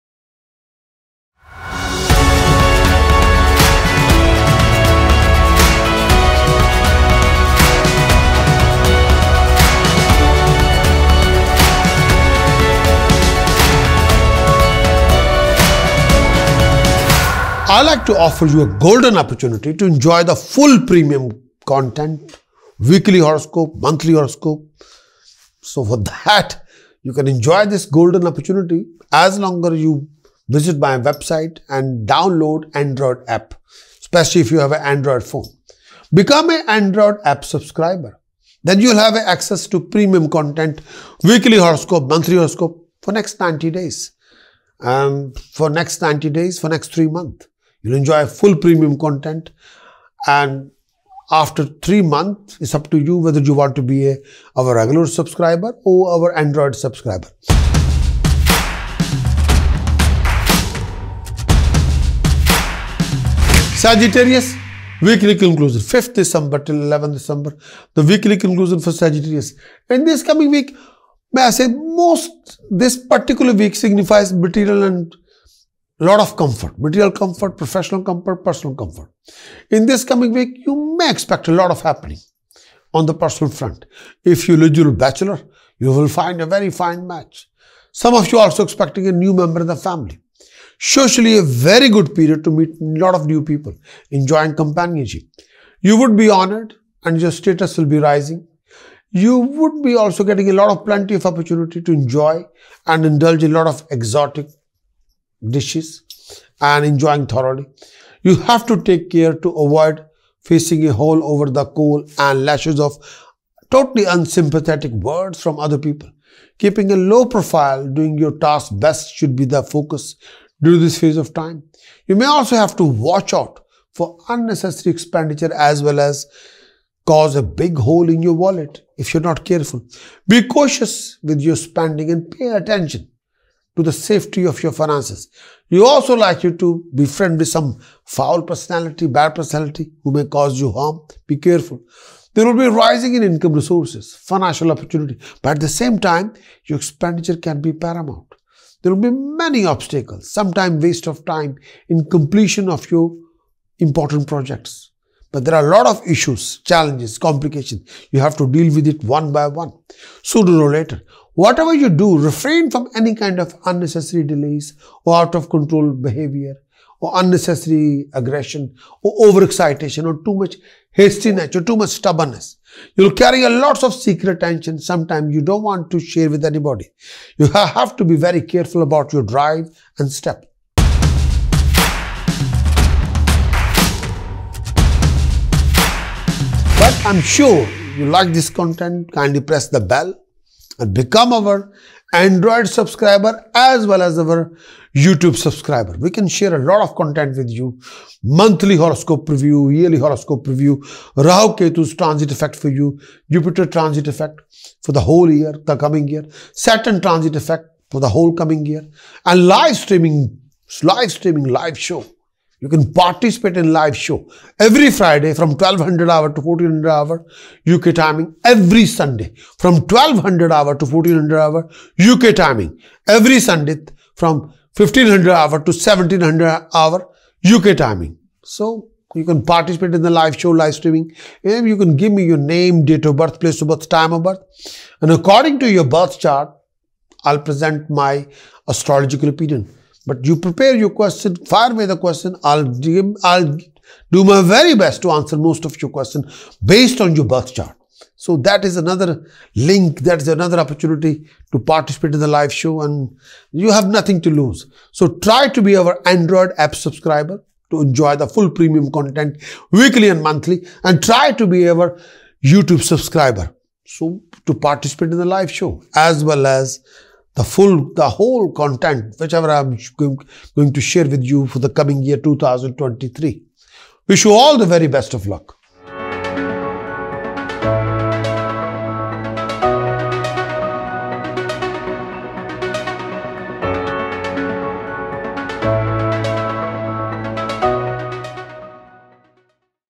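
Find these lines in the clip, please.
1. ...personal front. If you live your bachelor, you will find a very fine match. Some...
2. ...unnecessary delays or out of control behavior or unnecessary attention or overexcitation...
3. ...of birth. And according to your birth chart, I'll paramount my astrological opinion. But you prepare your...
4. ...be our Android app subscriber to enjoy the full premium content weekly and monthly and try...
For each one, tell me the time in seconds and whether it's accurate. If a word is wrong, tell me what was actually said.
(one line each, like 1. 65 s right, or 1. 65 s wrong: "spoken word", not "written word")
1. 83 s right
2. 163 s wrong: "aggression", not "attention"
3. 234 s wrong: "present", not "paramount"
4. 255 s right.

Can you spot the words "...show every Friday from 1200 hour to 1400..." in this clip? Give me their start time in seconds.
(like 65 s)
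213 s.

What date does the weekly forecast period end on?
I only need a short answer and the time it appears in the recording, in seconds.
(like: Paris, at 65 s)
11th December, at 66 s.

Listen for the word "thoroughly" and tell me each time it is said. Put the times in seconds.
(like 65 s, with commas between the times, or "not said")
107 s.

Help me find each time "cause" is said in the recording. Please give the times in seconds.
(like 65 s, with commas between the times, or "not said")
127 s, 140 s.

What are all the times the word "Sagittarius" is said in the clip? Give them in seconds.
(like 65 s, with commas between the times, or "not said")
63 s, 68 s.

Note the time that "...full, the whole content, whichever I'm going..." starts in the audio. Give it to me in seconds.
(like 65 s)
267 s.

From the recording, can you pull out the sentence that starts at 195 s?
We can share a lot of content with you.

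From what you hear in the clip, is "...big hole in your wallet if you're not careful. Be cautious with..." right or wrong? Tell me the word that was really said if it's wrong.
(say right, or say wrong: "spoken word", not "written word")
right.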